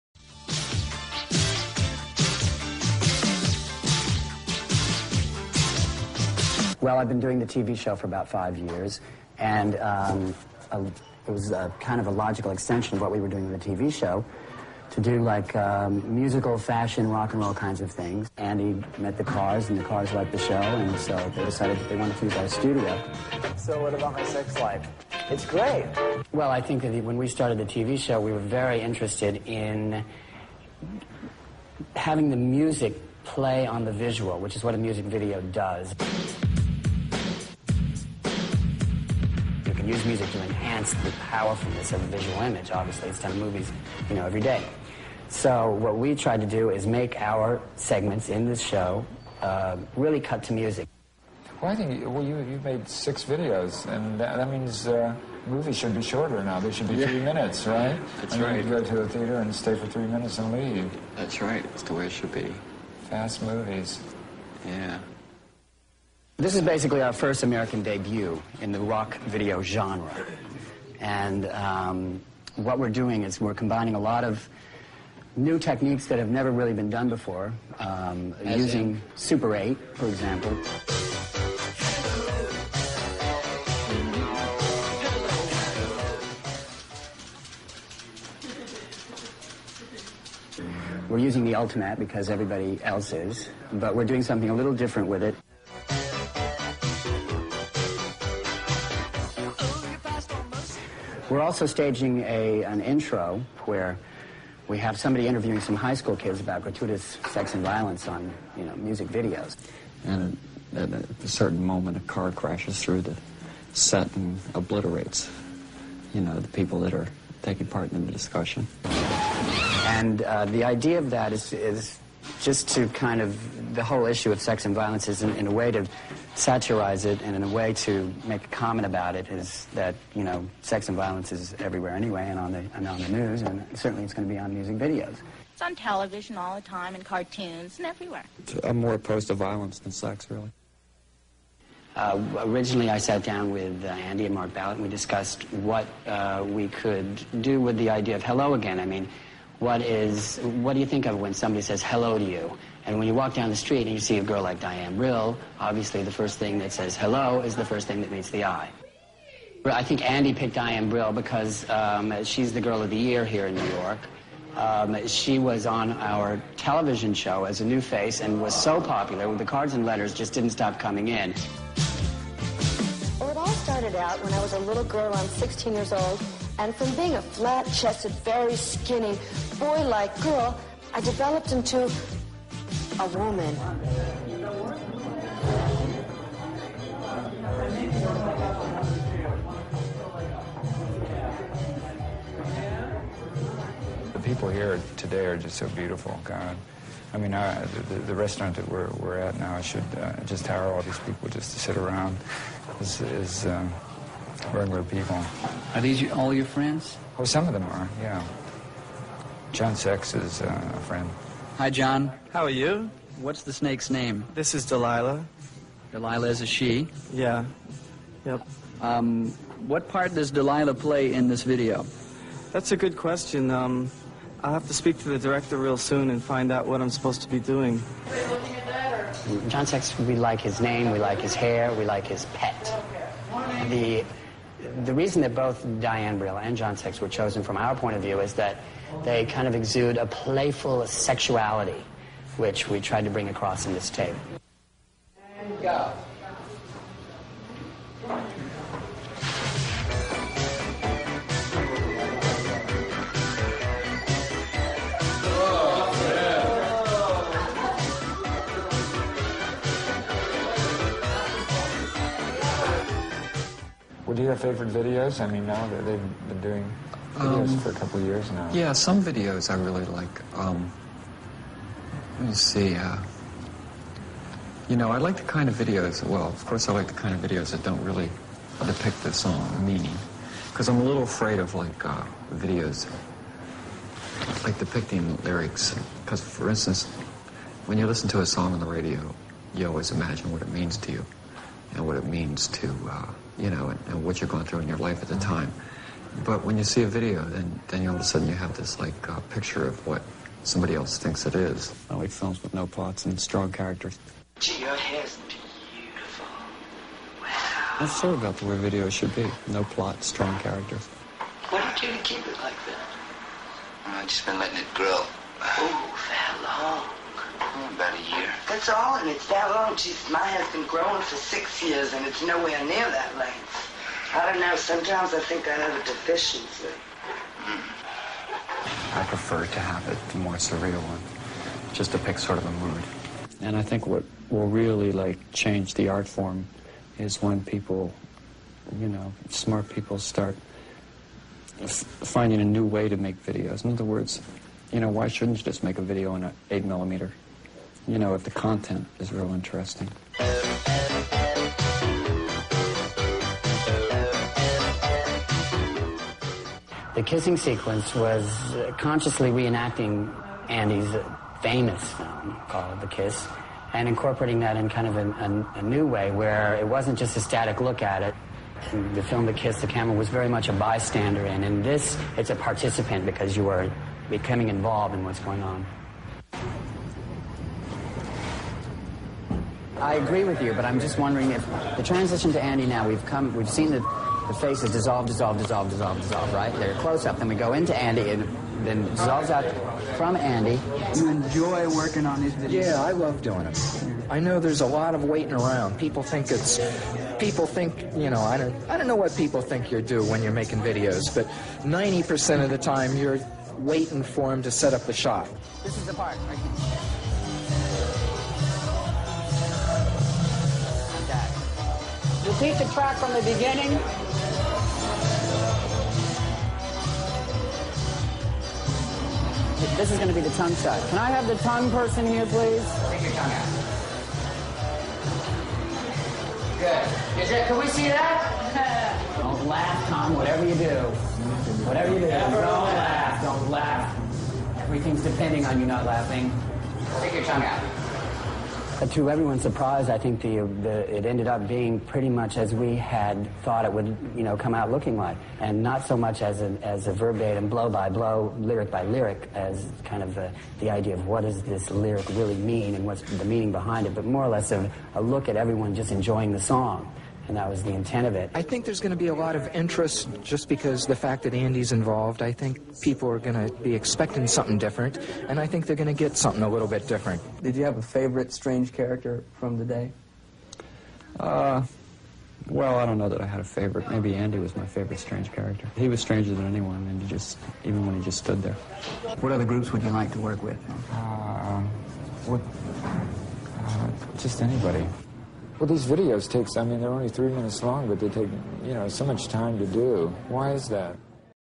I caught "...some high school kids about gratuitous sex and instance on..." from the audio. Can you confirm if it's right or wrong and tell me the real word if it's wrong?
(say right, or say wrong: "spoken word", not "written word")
wrong: "violence", not "instance".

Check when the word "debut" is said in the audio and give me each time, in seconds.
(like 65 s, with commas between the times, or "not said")
67 s.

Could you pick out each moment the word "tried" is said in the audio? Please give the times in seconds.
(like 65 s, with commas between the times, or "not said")
46 s, 242 s.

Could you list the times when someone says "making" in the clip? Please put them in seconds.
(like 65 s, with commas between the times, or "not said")
400 s.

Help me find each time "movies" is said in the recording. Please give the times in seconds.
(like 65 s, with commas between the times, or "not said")
43 s, 55 s, 63 s.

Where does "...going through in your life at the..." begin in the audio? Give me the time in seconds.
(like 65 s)
294 s.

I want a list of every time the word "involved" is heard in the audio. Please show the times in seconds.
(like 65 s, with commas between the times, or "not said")
374 s, 461 s.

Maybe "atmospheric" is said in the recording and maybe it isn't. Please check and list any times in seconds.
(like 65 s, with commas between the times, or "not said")
not said.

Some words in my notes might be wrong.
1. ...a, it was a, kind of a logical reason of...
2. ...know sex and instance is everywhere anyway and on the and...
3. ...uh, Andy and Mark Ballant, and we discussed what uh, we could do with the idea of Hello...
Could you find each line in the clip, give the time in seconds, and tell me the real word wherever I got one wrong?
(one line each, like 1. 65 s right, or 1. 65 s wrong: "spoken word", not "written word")
1. 10 s wrong: "extension", not "reason"
2. 130 s wrong: "violence", not "instance"
3. 143 s right.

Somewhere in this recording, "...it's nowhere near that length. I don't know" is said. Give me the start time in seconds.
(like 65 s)
322 s.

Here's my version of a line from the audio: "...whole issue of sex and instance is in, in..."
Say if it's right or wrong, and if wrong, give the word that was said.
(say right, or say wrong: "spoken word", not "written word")
wrong: "violence", not "instance".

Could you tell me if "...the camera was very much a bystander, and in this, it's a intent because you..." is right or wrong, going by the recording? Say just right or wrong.
wrong.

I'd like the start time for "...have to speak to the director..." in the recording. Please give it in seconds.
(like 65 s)
224 s.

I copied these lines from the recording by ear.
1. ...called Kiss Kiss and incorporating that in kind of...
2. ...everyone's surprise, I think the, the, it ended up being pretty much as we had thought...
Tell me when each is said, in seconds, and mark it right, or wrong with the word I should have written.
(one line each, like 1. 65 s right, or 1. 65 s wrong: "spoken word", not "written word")
1. 362 s wrong: "The", not "Kiss"
2. 439 s right.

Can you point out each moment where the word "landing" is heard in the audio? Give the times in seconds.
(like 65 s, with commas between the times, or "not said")
not said.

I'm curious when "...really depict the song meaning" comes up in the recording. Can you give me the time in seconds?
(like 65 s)
277 s.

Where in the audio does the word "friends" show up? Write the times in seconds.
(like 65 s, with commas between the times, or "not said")
206 s, 210 s.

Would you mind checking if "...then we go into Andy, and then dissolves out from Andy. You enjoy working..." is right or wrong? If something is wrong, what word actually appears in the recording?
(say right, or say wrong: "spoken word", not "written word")
right.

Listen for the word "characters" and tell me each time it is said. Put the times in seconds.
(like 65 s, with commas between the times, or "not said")
303 s, 310 s, 468 s, 475 s.